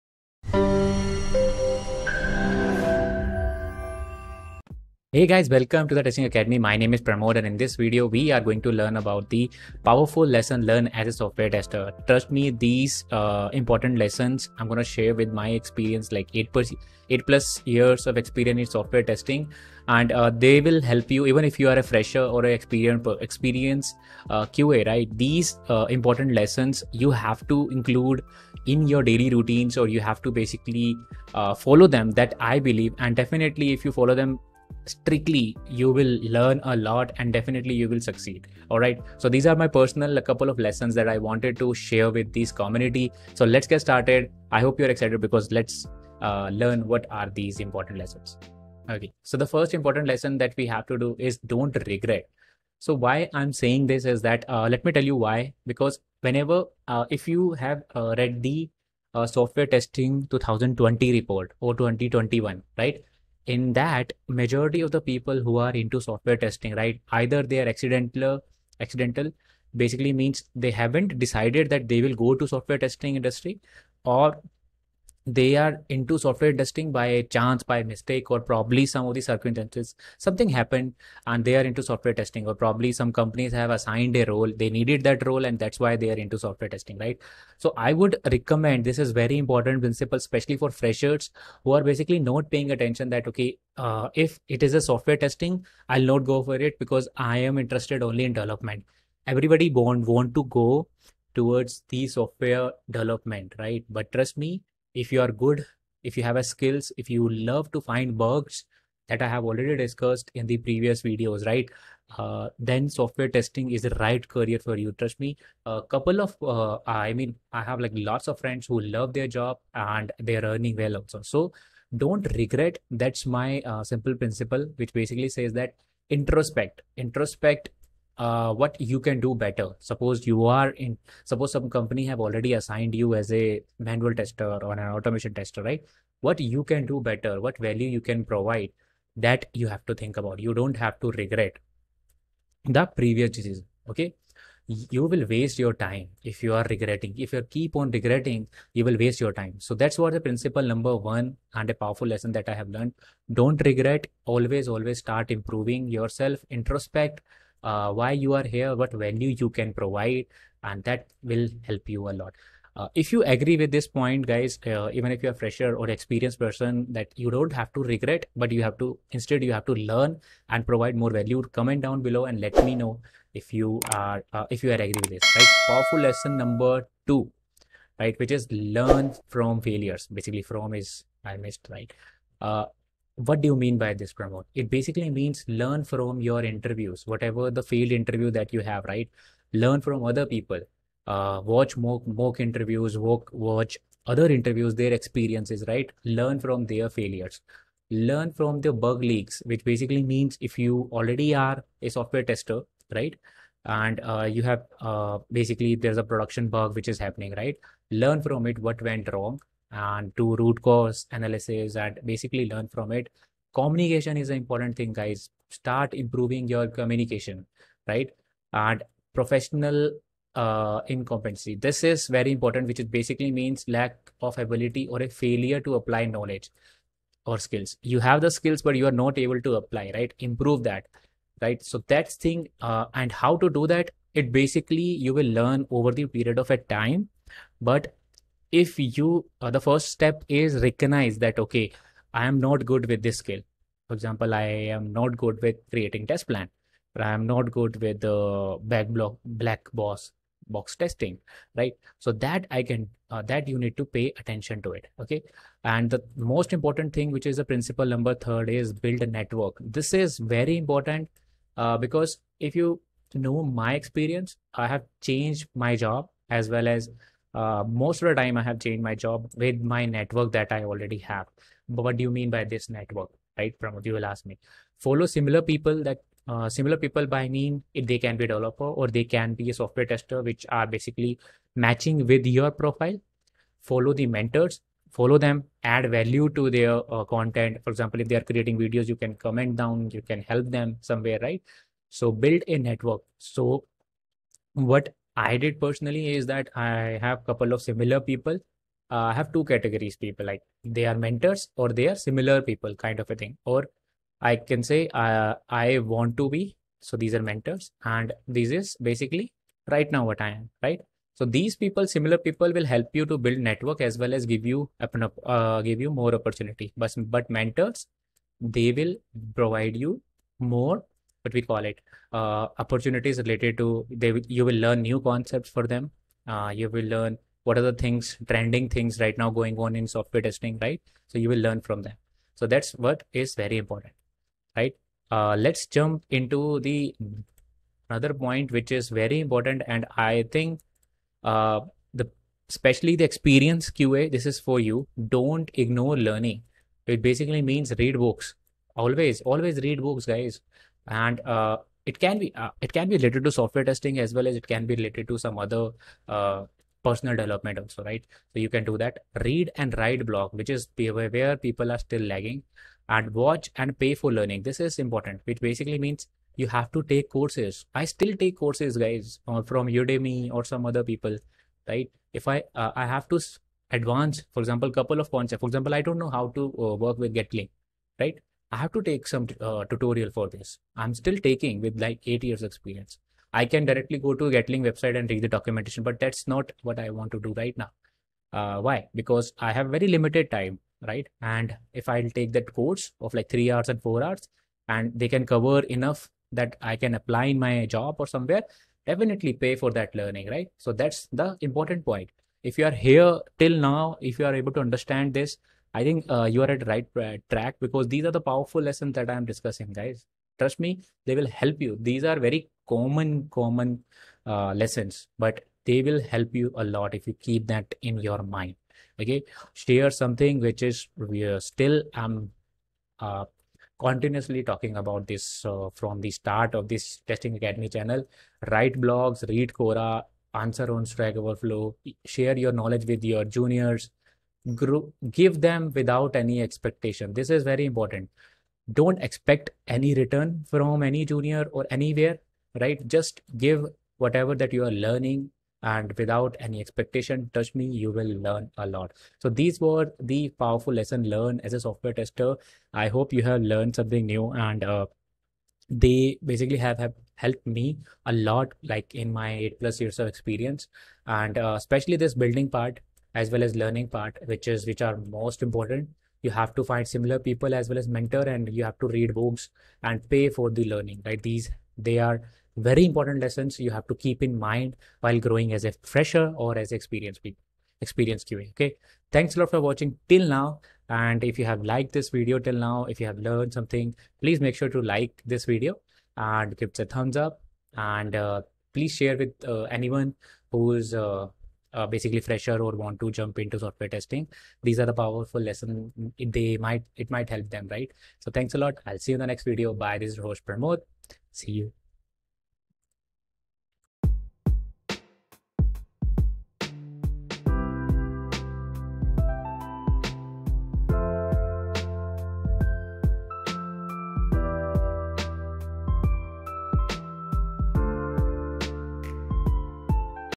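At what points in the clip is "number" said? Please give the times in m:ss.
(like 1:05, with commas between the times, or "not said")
2:30, 2:56, 4:17.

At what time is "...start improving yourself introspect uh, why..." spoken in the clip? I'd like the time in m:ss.
2:35.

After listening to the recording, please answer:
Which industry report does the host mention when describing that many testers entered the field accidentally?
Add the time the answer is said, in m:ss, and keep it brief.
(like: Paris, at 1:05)
Software testing 2020 report, at 0:59.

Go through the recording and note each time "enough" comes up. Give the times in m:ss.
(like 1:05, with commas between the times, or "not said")
6:35.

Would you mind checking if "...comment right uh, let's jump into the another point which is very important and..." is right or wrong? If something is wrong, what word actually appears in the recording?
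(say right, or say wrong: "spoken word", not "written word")
wrong: "important", not "comment".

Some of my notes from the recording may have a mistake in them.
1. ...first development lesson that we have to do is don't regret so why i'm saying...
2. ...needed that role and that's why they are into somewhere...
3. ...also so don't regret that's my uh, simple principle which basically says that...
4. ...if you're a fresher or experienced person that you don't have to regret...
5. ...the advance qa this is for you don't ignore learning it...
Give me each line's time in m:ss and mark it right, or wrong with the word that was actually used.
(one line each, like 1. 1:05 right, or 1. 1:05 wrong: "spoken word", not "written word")
1. 0:49 wrong: "important", not "development"
2. 1:24 wrong: "software", not "somewhere"
3. 2:00 right
4. 2:45 right
5. 5:42 wrong: "experience", not "advance".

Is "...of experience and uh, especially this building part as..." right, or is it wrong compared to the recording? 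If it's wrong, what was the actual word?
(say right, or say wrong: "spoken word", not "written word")
right.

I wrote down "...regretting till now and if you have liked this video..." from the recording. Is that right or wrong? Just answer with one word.
wrong.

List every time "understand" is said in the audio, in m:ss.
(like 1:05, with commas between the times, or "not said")
6:44.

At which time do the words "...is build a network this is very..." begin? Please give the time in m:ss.
4:18.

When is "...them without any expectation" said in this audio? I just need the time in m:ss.
7:15.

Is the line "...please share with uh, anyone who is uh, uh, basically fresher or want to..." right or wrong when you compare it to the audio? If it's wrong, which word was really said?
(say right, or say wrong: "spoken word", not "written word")
right.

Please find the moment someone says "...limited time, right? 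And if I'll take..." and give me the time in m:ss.
6:29.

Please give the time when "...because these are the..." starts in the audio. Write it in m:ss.
6:47.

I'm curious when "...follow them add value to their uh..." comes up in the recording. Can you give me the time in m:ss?
4:44.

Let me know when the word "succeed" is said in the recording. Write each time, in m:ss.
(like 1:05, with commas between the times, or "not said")
0:38.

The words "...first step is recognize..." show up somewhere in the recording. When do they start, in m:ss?
3:59.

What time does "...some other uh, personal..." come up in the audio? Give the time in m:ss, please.
5:55.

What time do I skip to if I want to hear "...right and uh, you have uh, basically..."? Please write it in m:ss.
3:22.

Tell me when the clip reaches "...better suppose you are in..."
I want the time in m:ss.
2:09.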